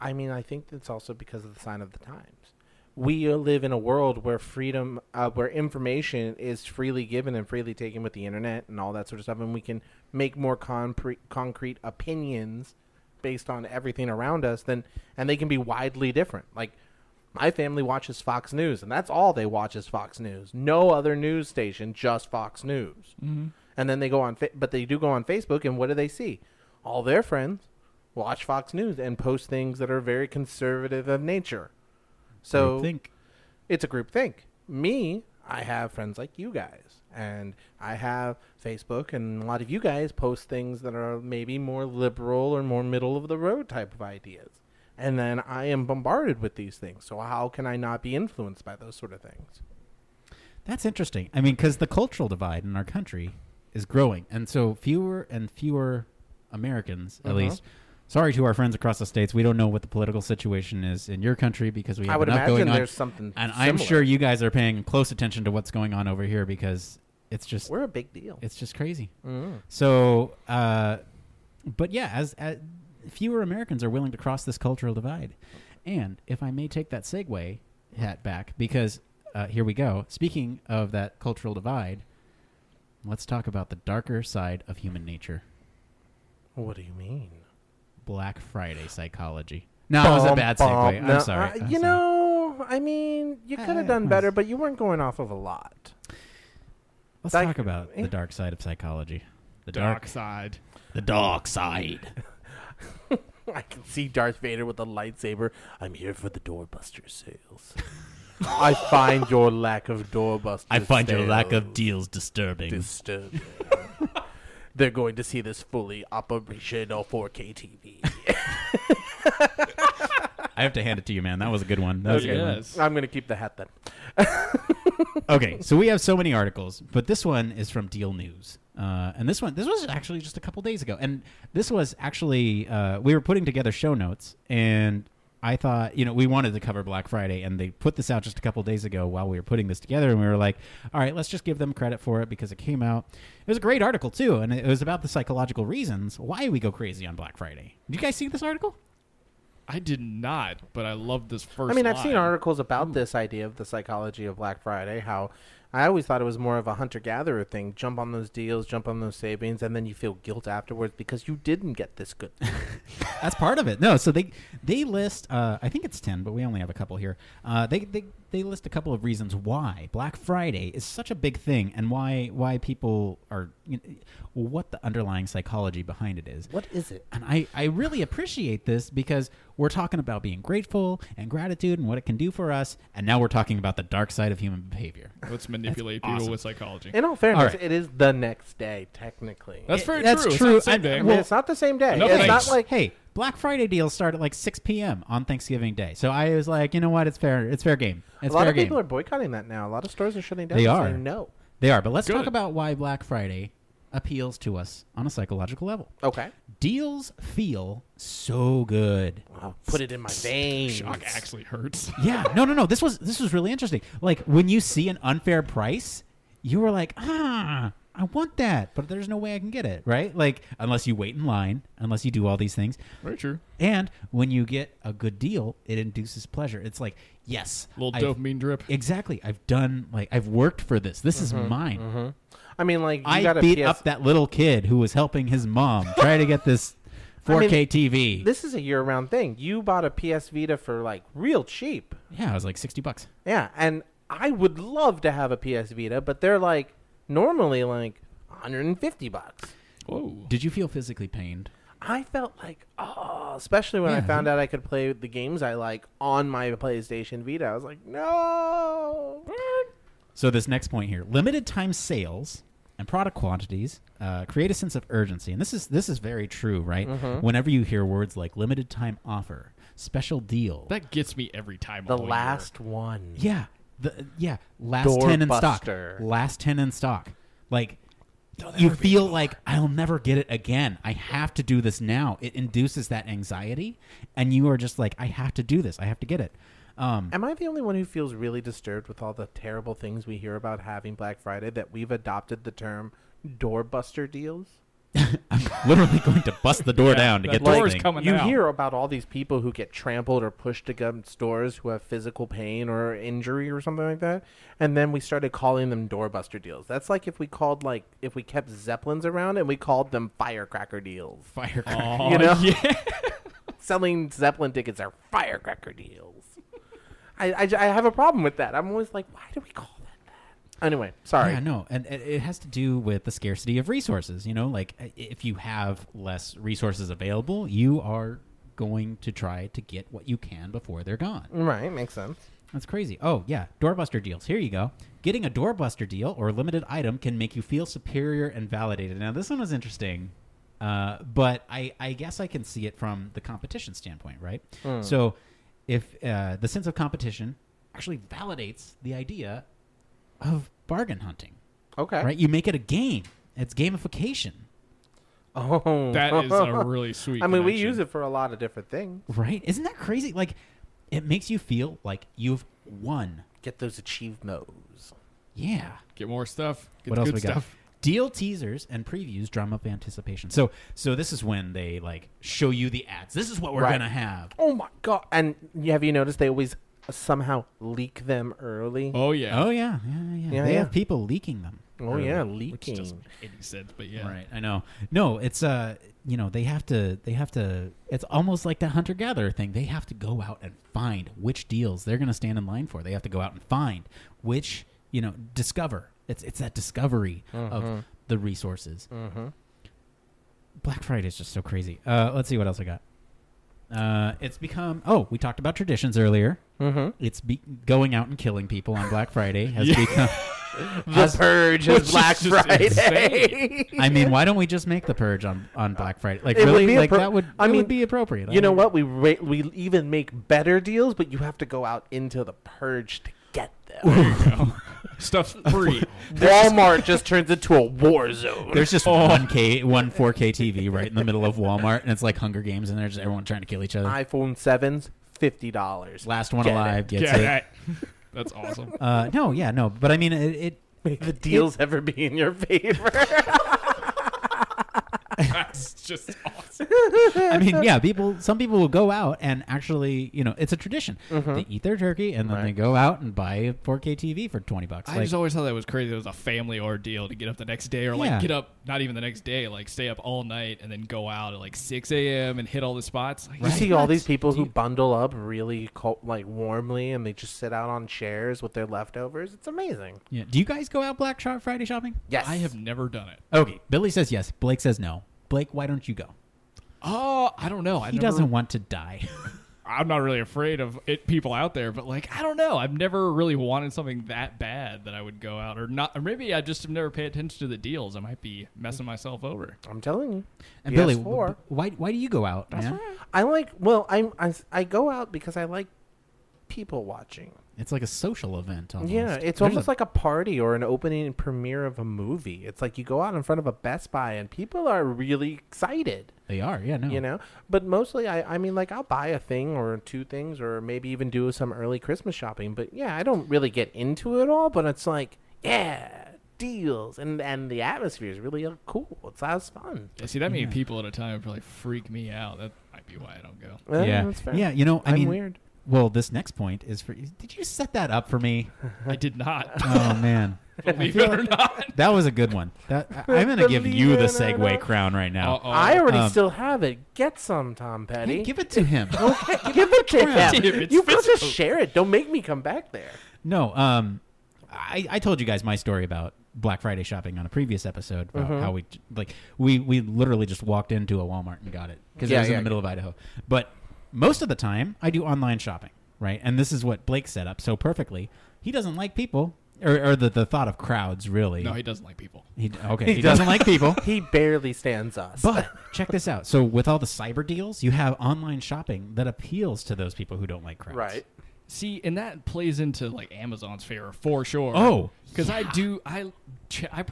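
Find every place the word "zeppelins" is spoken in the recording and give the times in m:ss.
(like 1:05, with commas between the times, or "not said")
5:08, 5:14.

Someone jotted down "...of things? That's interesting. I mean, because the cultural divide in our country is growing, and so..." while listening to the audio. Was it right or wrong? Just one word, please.
right.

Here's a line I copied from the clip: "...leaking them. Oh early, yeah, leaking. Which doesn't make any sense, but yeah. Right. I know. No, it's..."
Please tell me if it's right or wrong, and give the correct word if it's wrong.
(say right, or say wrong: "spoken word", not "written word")
right.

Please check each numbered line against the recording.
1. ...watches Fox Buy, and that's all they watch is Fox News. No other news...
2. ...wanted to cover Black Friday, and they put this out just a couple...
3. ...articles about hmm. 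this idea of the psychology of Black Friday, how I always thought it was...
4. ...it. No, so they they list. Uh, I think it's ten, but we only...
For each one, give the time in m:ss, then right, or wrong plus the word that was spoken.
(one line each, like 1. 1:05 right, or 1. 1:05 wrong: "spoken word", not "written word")
1. 0:17 wrong: "News", not "Buy"
2. 2:16 right
3. 2:32 right
4. 2:43 right.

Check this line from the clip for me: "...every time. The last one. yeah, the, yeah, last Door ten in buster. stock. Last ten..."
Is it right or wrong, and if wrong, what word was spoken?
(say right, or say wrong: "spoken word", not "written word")
right.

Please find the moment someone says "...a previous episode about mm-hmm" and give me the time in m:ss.
9:07.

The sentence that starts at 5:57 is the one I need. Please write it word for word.
we use it for a lot of different things.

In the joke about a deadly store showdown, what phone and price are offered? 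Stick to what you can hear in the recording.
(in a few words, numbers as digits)
iPhone 7 for $50.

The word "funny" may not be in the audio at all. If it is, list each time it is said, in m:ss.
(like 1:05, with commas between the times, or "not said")
not said.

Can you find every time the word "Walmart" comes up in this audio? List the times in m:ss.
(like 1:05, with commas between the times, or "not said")
7:06, 7:11, 9:11.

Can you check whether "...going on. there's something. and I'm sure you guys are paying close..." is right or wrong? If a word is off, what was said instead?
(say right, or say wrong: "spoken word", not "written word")
right.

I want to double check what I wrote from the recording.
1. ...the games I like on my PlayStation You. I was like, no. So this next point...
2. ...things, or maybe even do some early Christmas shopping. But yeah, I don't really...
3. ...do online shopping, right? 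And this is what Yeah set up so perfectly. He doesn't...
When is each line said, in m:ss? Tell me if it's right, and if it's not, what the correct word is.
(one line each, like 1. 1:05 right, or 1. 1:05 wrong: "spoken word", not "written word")
1. 4:14 wrong: "Vita", not "You"
2. 8:30 right
3. 9:14 wrong: "Blake", not "Yeah".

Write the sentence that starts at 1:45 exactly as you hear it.
I'm here for the doorbuster sales.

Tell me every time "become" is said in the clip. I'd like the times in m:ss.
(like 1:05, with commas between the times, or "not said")
6:44, 6:49.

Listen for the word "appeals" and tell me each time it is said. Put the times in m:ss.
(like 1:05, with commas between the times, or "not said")
3:23, 9:29.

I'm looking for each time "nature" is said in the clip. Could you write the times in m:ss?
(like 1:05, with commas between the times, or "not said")
0:31, 1:25.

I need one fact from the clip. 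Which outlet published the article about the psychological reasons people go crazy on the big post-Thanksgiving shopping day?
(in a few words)
Deal News.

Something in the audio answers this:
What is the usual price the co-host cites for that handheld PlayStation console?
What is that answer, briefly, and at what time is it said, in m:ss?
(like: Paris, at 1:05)
$150, at 4:08.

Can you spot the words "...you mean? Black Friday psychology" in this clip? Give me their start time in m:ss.
1:26.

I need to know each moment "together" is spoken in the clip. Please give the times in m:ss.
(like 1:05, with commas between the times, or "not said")
2:13, 2:19.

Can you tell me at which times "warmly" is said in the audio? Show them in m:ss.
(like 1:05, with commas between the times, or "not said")
7:46.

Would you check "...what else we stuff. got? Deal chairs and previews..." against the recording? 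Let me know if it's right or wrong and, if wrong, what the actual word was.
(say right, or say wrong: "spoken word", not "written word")
wrong: "teasers", not "chairs".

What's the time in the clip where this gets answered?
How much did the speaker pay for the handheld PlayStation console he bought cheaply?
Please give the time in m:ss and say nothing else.
4:02.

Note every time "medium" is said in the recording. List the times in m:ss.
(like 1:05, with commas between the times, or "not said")
not said.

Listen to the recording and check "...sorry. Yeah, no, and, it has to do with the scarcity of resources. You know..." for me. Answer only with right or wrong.
right.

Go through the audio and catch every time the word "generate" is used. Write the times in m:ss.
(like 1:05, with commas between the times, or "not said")
not said.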